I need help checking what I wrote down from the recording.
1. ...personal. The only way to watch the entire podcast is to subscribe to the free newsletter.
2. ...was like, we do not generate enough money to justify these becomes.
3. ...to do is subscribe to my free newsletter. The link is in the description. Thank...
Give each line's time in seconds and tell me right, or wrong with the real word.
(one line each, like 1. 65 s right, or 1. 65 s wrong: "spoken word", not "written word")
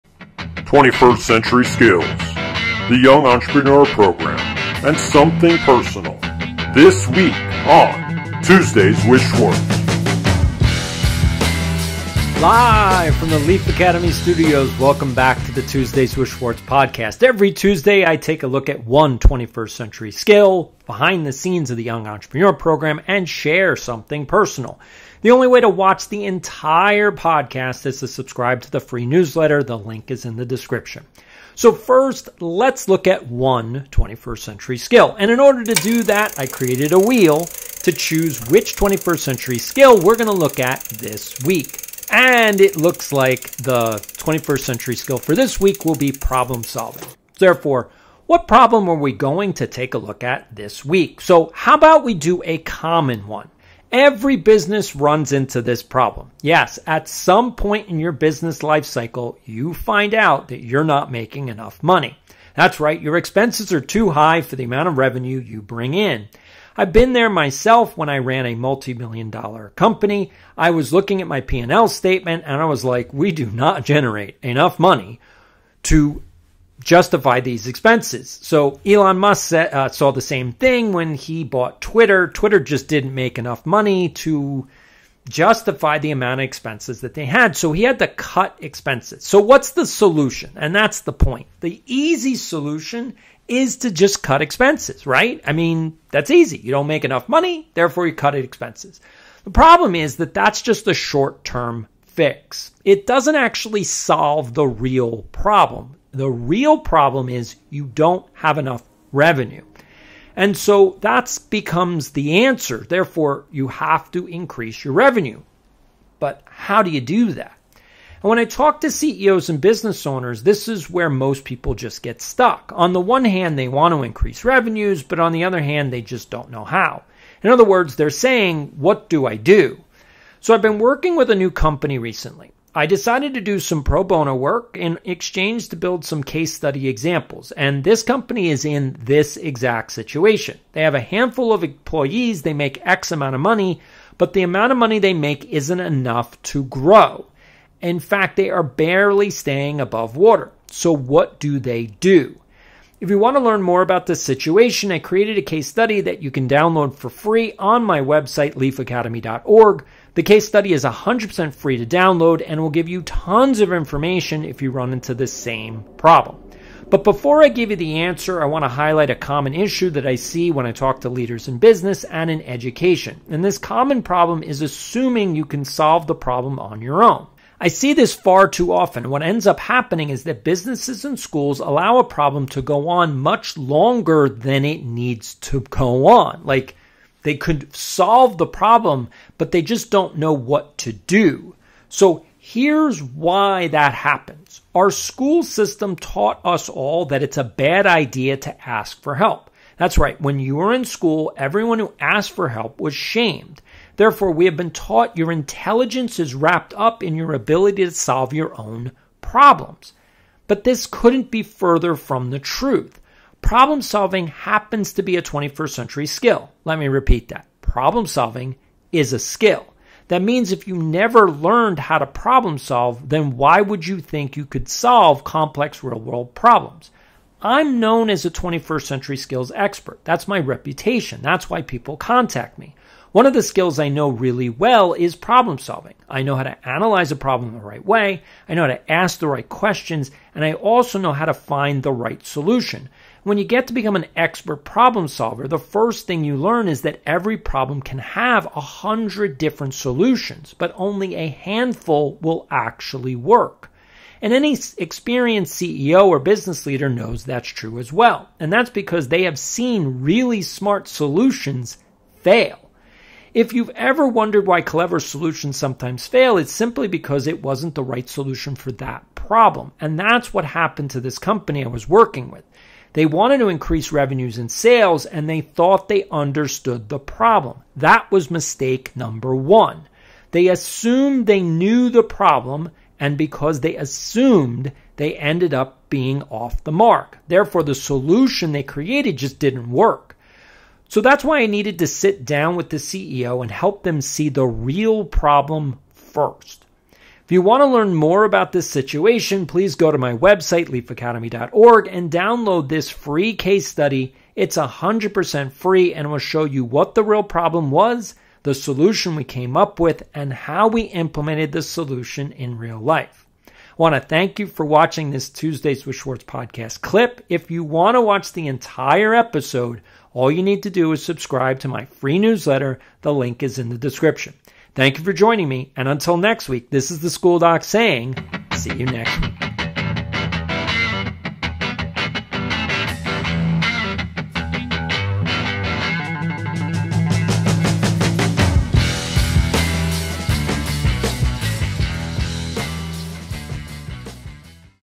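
1. 24 s right
2. 72 s wrong: "expenses", not "becomes"
3. 320 s right.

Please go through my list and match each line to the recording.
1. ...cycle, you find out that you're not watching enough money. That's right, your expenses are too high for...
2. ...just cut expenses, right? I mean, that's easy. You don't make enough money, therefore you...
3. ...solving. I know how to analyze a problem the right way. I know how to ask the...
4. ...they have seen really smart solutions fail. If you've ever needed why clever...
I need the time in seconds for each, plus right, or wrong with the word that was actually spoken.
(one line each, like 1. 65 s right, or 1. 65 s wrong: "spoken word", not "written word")
1. 58 s wrong: "making", not "watching"
2. 93 s right
3. 235 s right
4. 259 s wrong: "wondered", not "needed".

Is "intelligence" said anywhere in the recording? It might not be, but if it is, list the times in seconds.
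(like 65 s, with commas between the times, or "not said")
205 s.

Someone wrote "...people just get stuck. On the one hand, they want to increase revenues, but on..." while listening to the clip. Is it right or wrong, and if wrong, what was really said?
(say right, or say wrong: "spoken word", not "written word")
right.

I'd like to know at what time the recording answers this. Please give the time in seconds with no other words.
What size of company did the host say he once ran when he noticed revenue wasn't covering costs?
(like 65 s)
68 s.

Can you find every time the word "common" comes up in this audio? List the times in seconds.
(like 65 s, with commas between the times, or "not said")
52 s, 169 s, 173 s.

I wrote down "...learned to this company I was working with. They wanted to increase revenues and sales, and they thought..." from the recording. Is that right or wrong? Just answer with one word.
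wrong.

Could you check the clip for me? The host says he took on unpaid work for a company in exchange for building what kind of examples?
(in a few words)
Case study examples.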